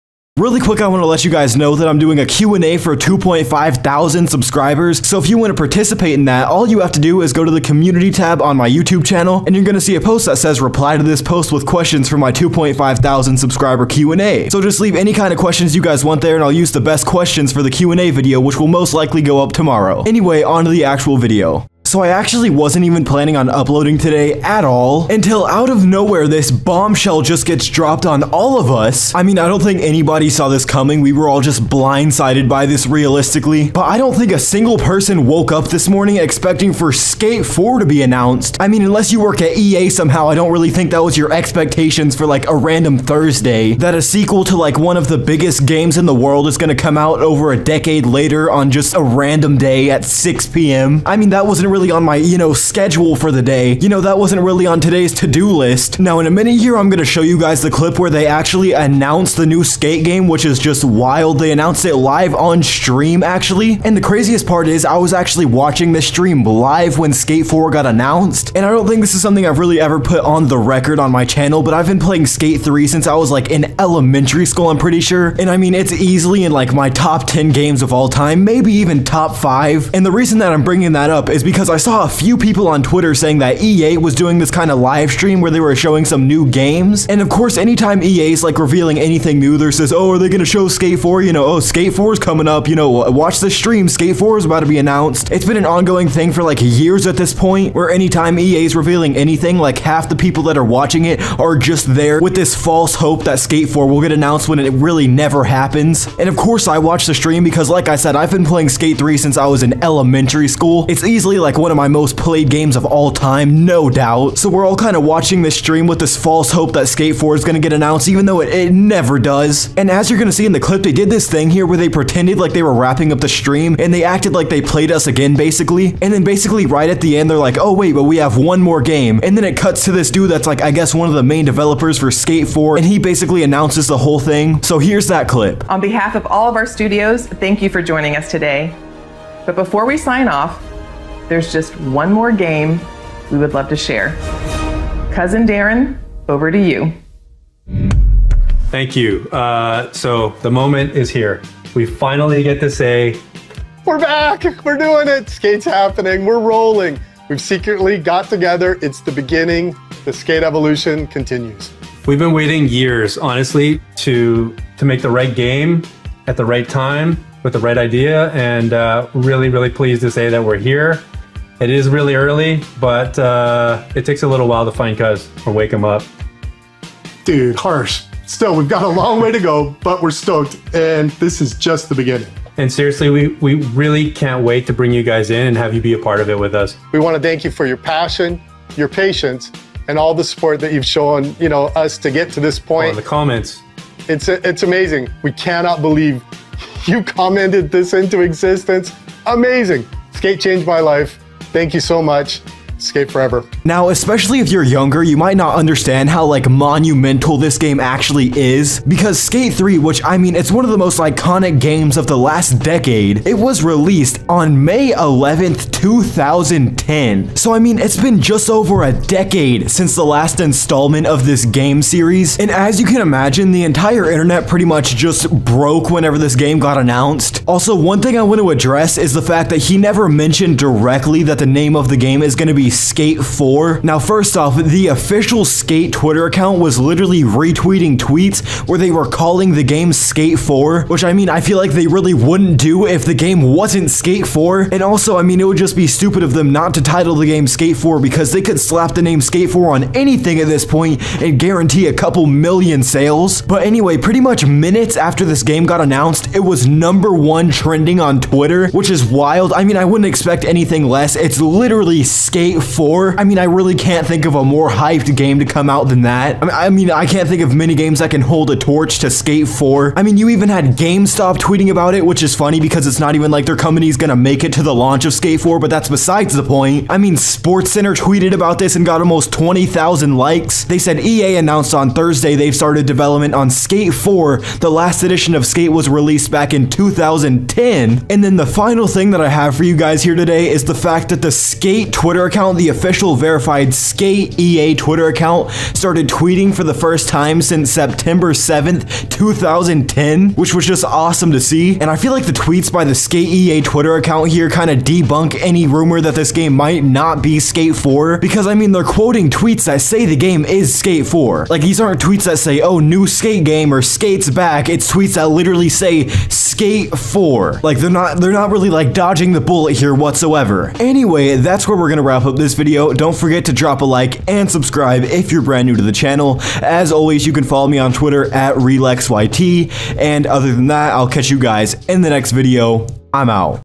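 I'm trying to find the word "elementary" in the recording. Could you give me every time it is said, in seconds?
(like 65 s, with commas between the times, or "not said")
73 s, 109 s.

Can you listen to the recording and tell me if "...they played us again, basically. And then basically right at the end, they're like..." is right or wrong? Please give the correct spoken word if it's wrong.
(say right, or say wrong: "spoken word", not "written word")
right.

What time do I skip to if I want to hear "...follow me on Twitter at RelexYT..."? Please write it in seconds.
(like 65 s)
327 s.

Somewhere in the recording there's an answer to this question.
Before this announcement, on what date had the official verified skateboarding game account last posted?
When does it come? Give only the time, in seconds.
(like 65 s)
297 s.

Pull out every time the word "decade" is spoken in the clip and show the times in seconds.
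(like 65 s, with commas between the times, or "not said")
47 s, 212 s, 218 s.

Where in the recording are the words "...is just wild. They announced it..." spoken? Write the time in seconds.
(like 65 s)
60 s.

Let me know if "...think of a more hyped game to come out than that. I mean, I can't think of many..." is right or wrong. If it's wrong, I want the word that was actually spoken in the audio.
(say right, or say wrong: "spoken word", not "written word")
right.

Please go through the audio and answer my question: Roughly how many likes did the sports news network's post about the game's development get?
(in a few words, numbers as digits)
almost 20,000.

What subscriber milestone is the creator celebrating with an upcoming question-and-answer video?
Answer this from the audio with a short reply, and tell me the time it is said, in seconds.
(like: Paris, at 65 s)
2.5 thousand, at 2 s.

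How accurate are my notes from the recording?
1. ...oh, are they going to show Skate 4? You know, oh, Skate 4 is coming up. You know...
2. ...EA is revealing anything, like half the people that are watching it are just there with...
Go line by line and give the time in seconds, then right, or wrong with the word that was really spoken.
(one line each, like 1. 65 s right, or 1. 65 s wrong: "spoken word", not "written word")
1. 89 s right
2. 98 s right.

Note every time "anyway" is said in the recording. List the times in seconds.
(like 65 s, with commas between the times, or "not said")
20 s, 253 s, 320 s.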